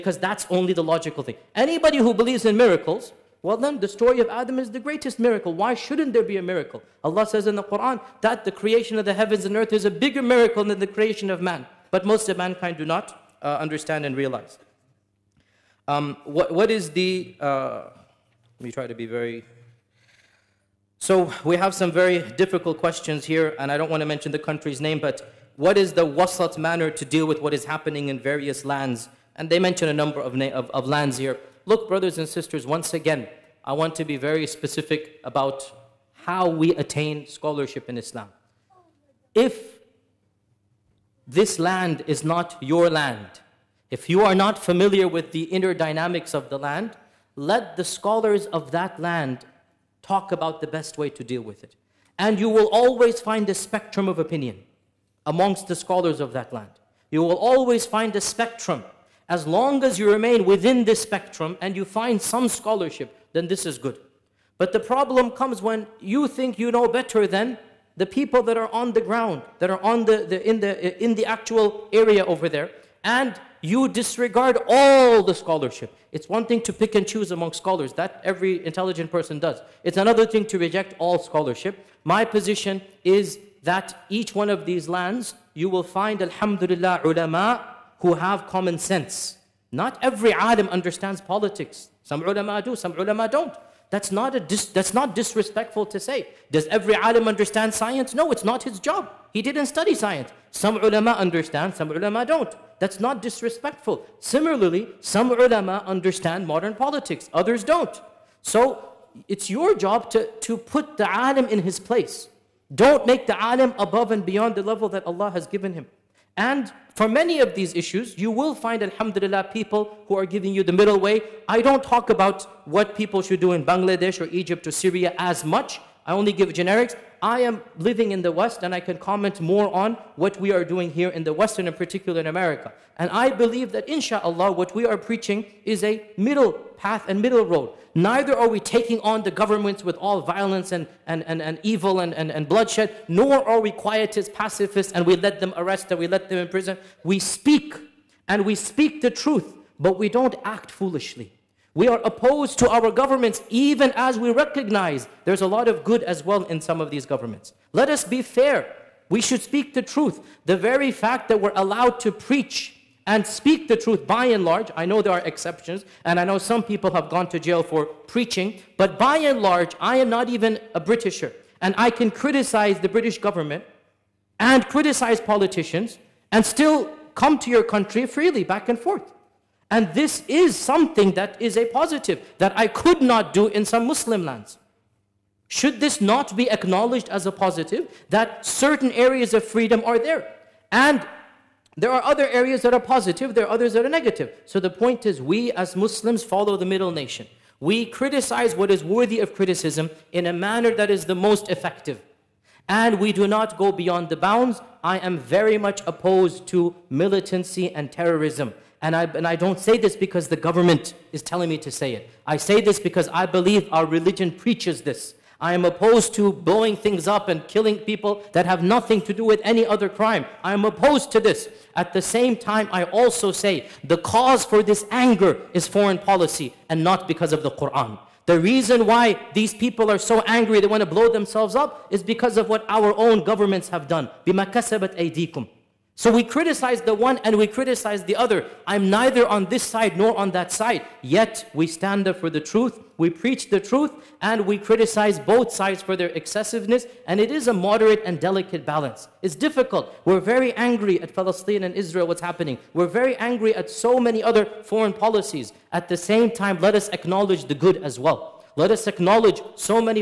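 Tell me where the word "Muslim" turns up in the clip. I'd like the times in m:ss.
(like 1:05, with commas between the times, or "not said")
3:03, 3:15.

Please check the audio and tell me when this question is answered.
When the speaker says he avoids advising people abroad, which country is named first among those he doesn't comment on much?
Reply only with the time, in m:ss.
2:03.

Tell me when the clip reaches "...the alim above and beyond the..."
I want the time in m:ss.
1:53.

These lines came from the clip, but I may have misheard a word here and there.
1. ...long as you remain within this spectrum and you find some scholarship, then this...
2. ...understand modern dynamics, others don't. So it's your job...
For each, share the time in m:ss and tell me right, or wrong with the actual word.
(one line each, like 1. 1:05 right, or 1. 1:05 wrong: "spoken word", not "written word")
1. 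0:59 right
2. 1:45 wrong: "politics", not "dynamics".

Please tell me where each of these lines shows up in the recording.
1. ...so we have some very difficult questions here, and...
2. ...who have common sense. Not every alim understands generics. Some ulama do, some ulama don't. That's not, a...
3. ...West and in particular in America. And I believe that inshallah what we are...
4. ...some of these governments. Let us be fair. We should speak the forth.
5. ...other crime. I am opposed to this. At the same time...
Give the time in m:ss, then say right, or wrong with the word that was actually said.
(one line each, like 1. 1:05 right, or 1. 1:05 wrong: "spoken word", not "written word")
1. 0:20 right
2. 1:27 wrong: "politics", not "generics"
3. 2:11 right
4. 2:36 wrong: "truth", not "forth"
5. 3:39 right.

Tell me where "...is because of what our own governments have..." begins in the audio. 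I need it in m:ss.
3:51.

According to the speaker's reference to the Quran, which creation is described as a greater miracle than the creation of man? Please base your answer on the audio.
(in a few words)
The heavens and earth.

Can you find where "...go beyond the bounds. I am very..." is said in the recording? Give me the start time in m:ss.
3:23.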